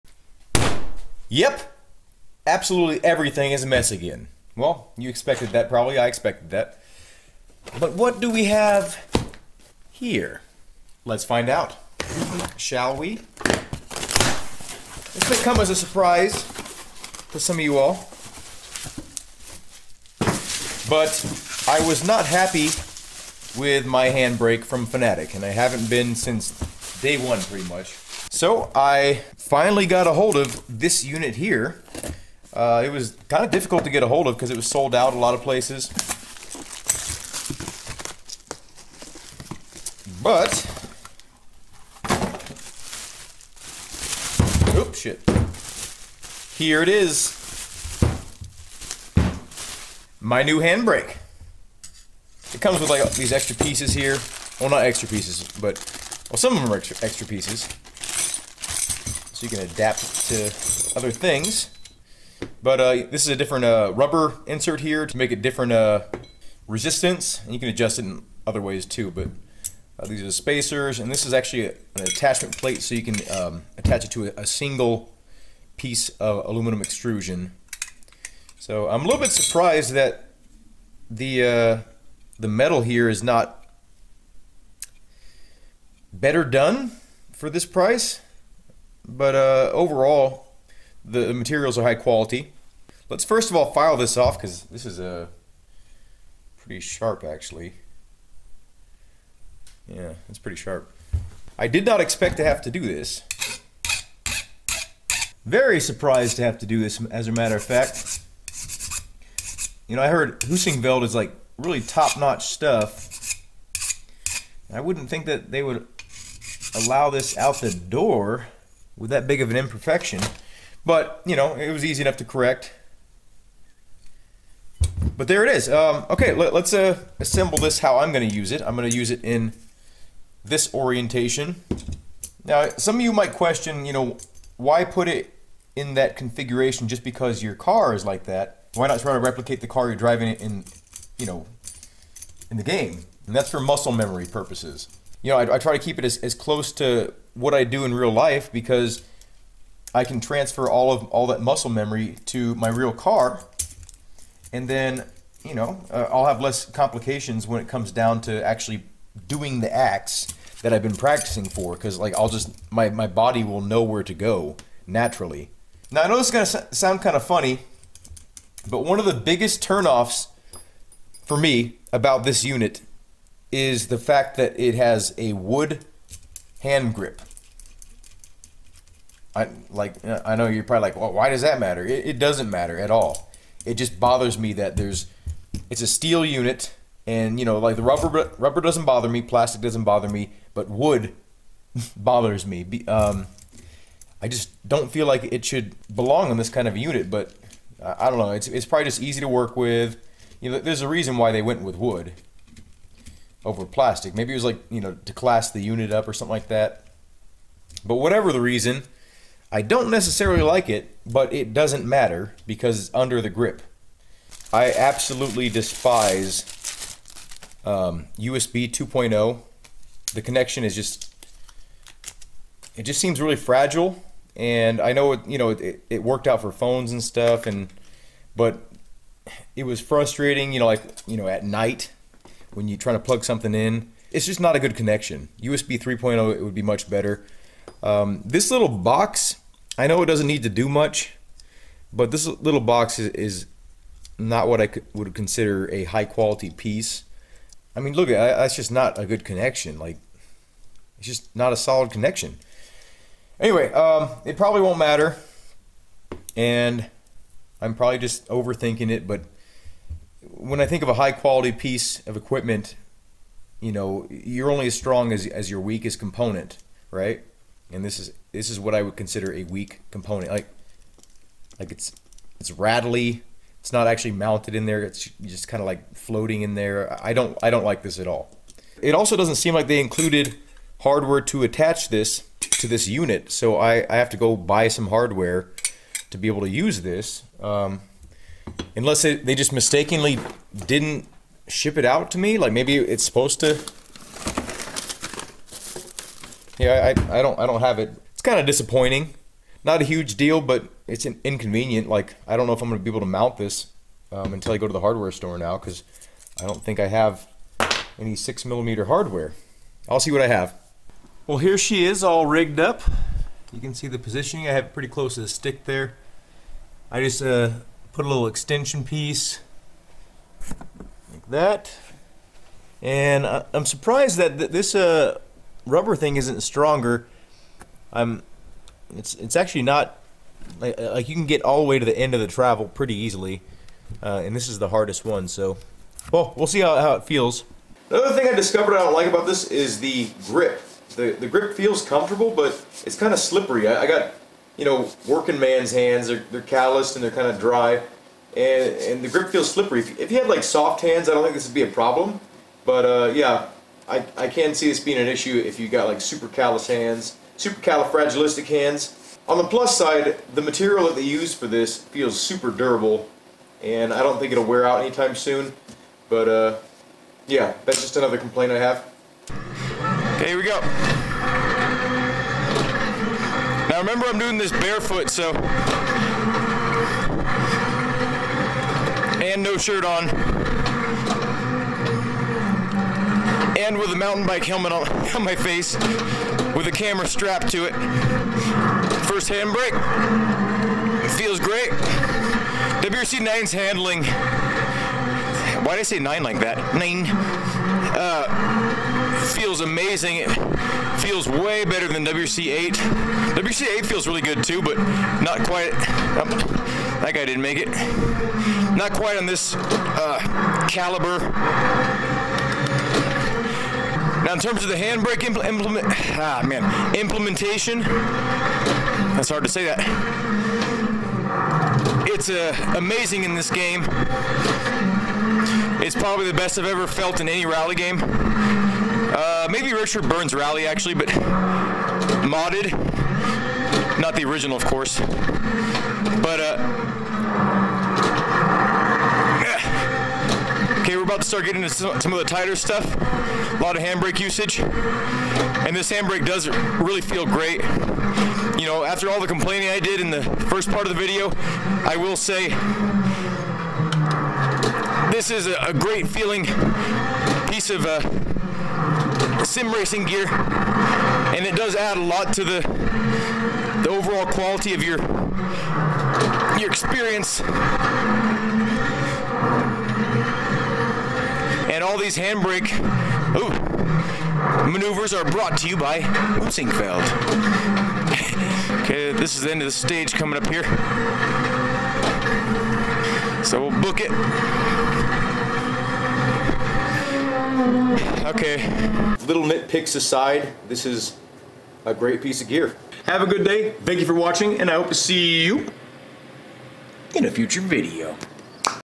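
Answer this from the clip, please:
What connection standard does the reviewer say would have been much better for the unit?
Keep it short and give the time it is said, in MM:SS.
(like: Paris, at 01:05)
USB 3.0, at 03:55.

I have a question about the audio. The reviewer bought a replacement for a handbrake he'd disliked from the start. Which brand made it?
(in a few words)
Fanatec.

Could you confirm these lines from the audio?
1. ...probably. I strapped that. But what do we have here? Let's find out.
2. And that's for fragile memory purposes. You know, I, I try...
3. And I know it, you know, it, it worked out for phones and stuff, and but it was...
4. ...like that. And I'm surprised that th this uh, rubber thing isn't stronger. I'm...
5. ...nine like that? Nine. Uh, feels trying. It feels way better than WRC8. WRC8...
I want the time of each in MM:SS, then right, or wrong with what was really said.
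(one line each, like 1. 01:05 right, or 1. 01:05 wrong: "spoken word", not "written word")
1. 00:05 wrong: "expected", not "strapped"
2. 02:23 wrong: "muscle", not "fragile"
3. 03:44 right
4. 05:20 right
5. 06:35 wrong: "amazing", not "trying".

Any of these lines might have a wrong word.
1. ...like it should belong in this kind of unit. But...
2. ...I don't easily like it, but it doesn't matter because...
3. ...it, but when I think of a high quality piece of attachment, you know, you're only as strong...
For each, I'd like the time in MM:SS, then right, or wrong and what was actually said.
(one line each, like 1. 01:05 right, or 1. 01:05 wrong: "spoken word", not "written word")
1. 03:15 right
2. 03:29 wrong: "necessarily", not "easily"
3. 04:18 wrong: "equipment", not "attachment".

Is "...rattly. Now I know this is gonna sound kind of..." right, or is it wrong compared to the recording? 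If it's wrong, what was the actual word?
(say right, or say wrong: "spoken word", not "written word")
wrong: "naturally", not "rattly".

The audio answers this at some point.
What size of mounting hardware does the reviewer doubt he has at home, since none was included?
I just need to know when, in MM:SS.
05:08.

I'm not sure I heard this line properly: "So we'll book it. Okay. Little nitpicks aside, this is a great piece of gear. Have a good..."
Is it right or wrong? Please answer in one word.
right.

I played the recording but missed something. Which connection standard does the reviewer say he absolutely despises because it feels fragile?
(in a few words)
USB 2.0.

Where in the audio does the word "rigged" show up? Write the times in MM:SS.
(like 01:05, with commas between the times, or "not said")
05:12.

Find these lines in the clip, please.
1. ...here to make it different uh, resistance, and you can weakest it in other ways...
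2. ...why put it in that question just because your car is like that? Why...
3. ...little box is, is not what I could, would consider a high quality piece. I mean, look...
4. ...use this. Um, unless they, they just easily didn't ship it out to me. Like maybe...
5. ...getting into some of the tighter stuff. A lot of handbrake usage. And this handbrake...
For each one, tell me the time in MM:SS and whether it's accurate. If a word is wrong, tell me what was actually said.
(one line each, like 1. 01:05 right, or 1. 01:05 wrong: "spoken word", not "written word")
1. 01:04 wrong: "adjust", not "weakest"
2. 02:14 wrong: "configuration", not "question"
3. 04:02 right
4. 04:46 wrong: "mistakenly", not "easily"
5. 07:21 right.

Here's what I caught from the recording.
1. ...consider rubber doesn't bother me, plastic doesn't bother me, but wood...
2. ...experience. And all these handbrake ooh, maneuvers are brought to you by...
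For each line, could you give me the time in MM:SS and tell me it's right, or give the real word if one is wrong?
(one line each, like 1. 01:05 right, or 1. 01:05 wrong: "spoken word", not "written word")
1. 03:07 wrong: "rubber", not "consider"
2. 07:46 right.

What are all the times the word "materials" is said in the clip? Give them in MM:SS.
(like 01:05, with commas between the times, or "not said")
01:31, 06:00.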